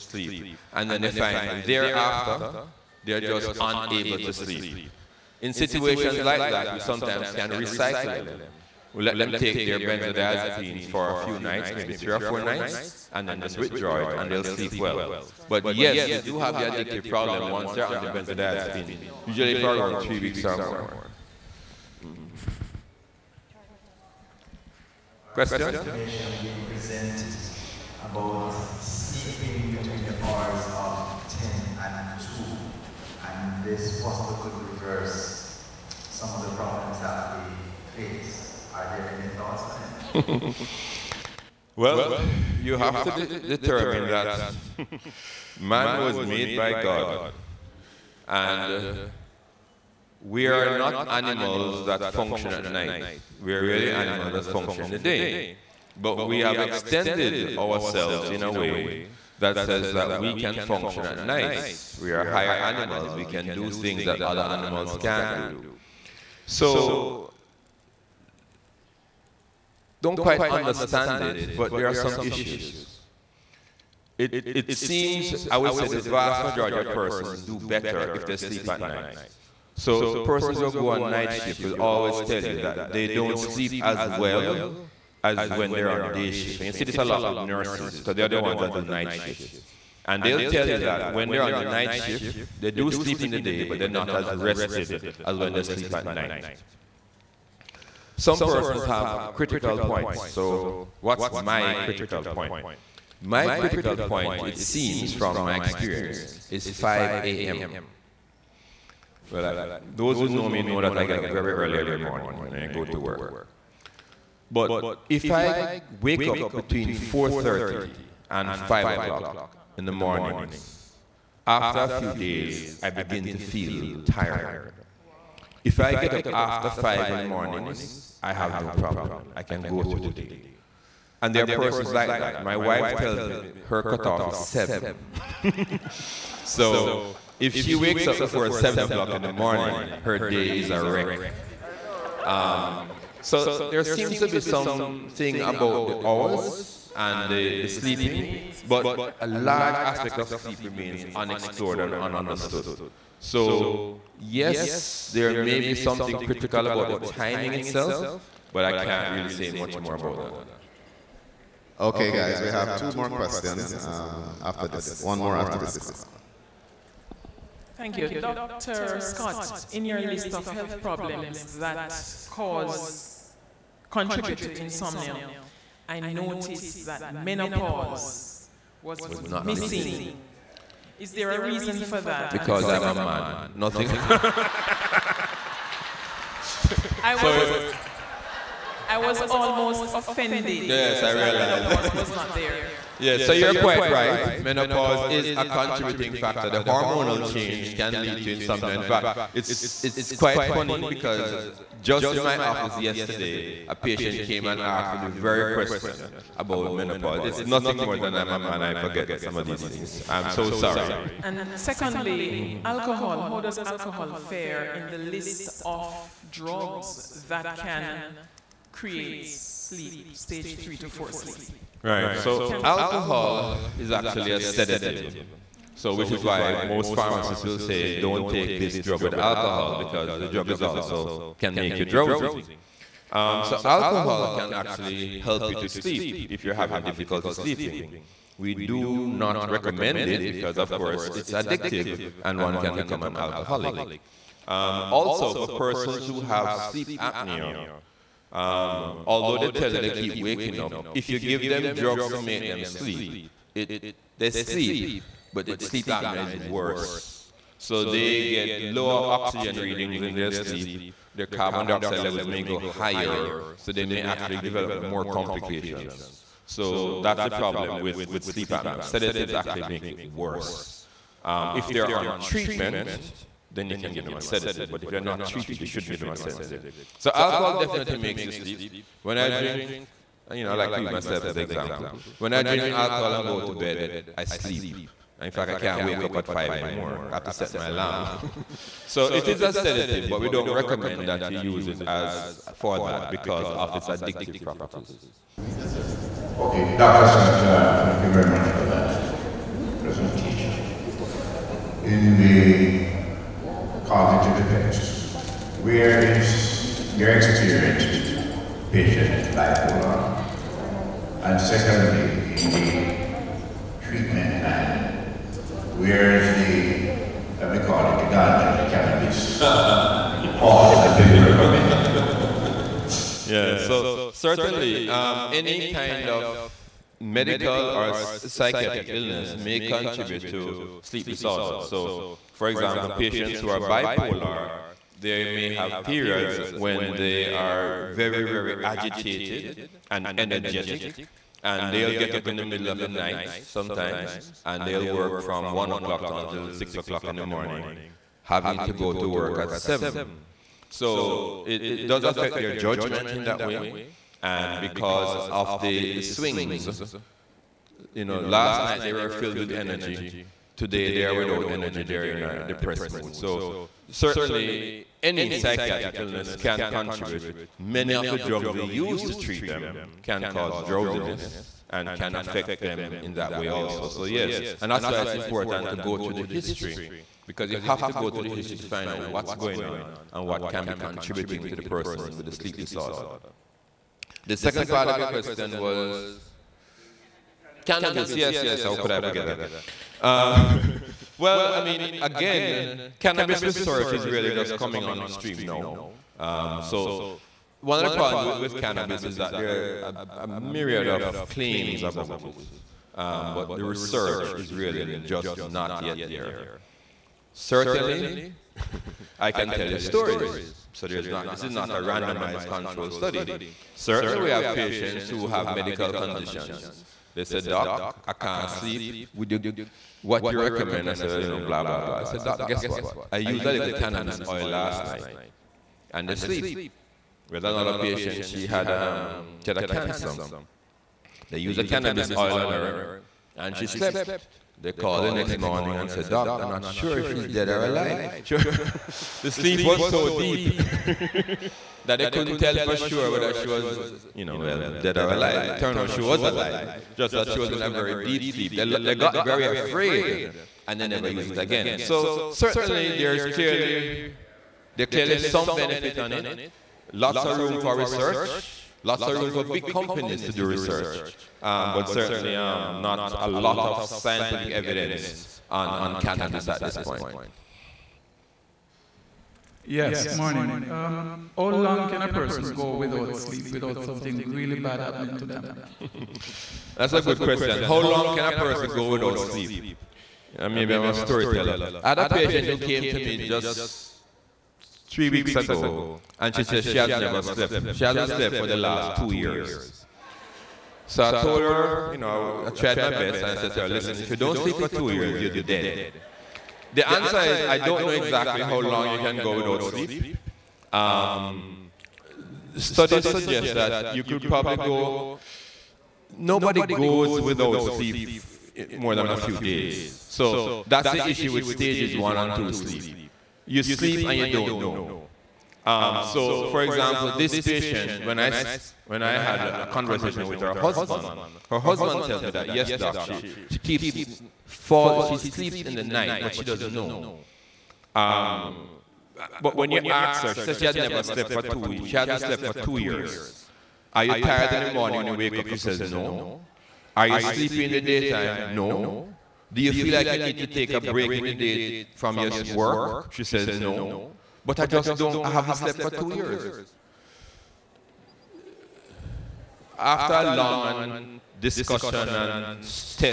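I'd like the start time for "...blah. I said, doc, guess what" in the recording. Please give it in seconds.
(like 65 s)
421 s.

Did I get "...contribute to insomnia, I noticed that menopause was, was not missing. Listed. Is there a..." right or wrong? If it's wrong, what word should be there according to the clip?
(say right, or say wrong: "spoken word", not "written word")
right.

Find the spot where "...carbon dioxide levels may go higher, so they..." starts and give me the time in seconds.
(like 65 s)
261 s.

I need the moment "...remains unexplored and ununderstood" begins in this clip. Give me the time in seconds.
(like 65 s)
150 s.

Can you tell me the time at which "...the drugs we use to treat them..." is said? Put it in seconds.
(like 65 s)
368 s.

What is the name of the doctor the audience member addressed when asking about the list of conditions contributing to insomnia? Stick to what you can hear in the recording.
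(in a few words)
Dr. Scott.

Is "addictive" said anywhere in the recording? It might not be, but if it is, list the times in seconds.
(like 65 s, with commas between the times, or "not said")
16 s, 241 s, 293 s.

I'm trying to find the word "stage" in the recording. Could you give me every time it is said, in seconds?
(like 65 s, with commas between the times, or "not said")
220 s, 511 s.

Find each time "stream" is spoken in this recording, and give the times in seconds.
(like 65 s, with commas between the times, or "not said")
395 s.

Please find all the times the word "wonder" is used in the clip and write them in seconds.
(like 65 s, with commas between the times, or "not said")
not said.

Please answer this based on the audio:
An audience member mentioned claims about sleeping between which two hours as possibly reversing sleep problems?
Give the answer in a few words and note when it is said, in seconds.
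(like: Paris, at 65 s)
10 and 2, at 31 s.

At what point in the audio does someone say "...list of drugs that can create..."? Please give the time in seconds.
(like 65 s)
214 s.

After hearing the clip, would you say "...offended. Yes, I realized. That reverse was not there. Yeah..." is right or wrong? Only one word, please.
wrong.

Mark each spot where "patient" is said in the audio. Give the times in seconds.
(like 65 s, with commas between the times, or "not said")
203 s, 308 s, 332 s, 414 s, 427 s, 482 s, 517 s.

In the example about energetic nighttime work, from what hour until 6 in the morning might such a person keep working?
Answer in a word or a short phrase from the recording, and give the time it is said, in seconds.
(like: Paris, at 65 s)
1 o'clock, at 345 s.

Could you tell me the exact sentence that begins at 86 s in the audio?
And you see this a lot with nurses, because they're the ones that do night shifts.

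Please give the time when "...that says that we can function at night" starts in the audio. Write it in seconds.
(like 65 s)
59 s.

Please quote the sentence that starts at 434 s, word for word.
They called the next morning and said, Doc, I'm not sure if she's dead or alive.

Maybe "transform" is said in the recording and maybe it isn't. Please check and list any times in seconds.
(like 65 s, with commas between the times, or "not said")
not said.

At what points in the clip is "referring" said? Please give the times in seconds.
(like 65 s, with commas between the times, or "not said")
not said.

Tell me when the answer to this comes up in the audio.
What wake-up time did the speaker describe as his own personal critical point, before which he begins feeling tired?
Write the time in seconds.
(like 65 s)
106 s.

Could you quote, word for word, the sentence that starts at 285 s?
In fact, I can't wake up at 5 anymore.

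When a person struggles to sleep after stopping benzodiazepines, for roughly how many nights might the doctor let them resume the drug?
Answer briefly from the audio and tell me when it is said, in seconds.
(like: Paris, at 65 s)
3 or 4 nights, at 11 s.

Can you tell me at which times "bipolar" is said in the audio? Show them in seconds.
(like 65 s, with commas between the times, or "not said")
309 s, 333 s.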